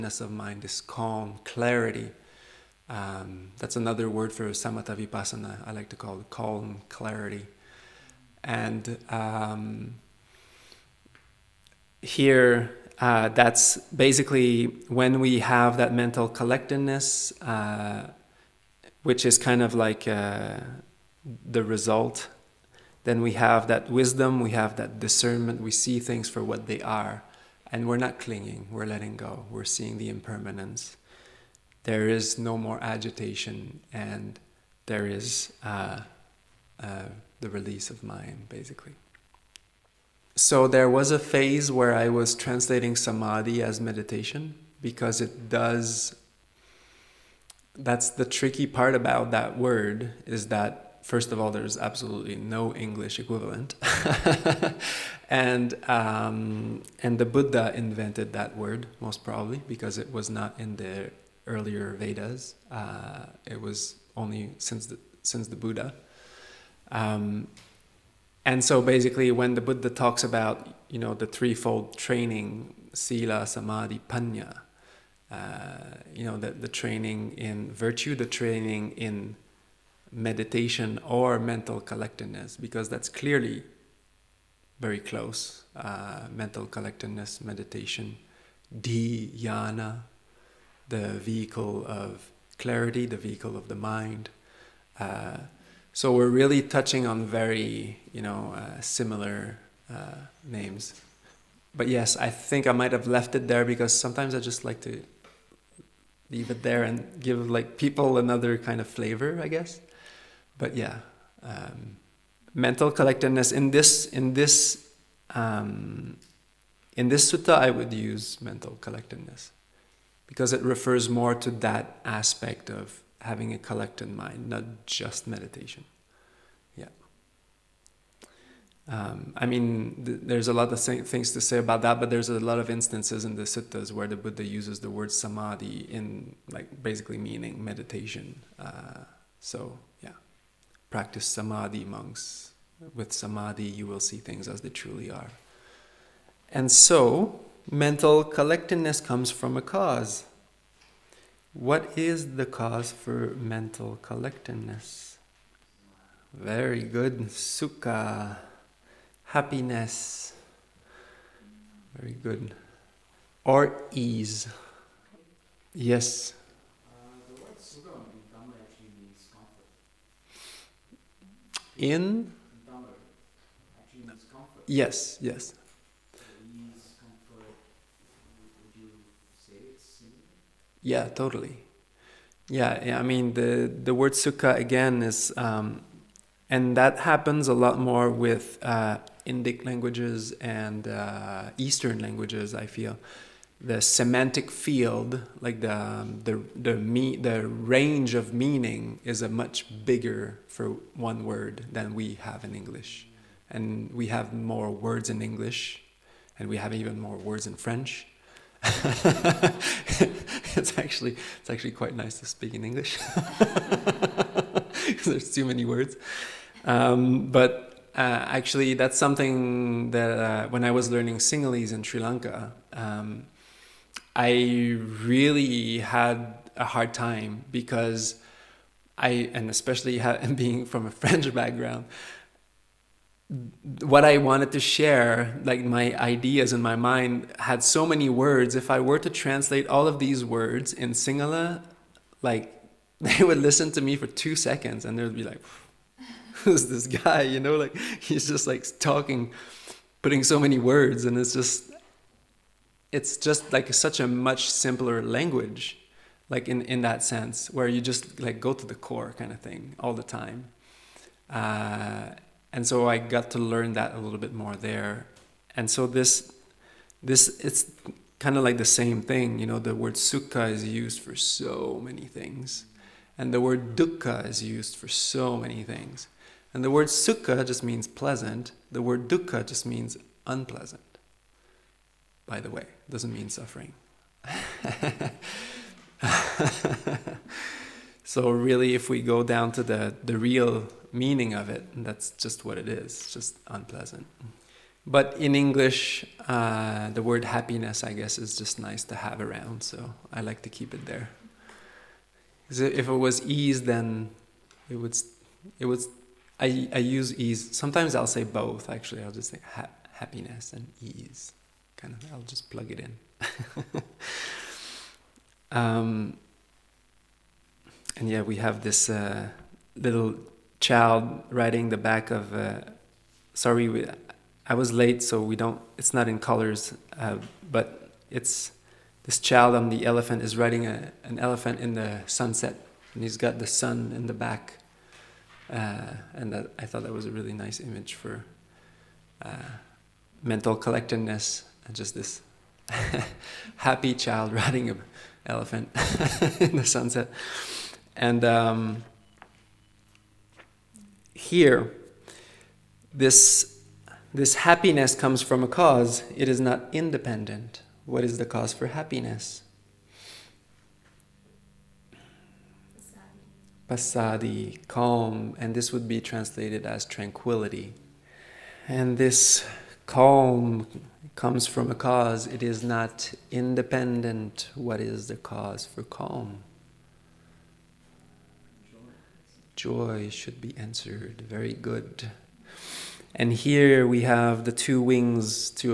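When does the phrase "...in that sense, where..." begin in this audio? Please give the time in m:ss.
4:16.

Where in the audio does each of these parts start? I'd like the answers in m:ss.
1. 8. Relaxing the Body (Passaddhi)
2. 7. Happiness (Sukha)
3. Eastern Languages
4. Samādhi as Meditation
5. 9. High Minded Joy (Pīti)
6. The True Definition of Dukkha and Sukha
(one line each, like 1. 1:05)
1. 5:51
2. 2:23
3. 3:03
4. 0:37
5. 6:05
6. 4:26.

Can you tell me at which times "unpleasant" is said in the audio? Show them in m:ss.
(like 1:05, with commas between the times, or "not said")
4:40, 4:53.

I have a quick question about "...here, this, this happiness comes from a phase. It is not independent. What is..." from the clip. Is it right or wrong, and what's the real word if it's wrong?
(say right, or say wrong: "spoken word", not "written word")
wrong: "cause", not "phase".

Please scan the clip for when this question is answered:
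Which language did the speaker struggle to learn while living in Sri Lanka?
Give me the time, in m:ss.
3:41.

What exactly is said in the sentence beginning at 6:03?
passaddhi, calm, and this would be translated as tranquility.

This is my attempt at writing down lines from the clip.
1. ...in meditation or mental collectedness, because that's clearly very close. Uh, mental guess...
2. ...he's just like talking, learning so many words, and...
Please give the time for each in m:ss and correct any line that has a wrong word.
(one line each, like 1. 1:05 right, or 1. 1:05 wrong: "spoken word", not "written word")
1. 1:18 wrong: "collectedness", not "guess"
2. 4:08 wrong: "putting", not "learning".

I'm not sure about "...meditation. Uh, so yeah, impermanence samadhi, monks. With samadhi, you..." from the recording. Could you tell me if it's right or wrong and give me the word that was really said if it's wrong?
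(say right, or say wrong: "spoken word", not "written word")
wrong: "practice", not "impermanence".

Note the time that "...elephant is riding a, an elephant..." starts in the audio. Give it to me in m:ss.
5:29.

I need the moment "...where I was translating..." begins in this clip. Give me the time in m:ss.
0:41.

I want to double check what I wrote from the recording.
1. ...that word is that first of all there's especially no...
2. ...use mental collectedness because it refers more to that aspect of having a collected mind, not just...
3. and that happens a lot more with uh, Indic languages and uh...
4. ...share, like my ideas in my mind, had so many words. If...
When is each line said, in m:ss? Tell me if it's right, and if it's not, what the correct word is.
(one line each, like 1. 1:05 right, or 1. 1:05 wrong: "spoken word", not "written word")
1. 0:49 wrong: "absolutely", not "especially"
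2. 1:57 right
3. 3:06 right
4. 3:54 right.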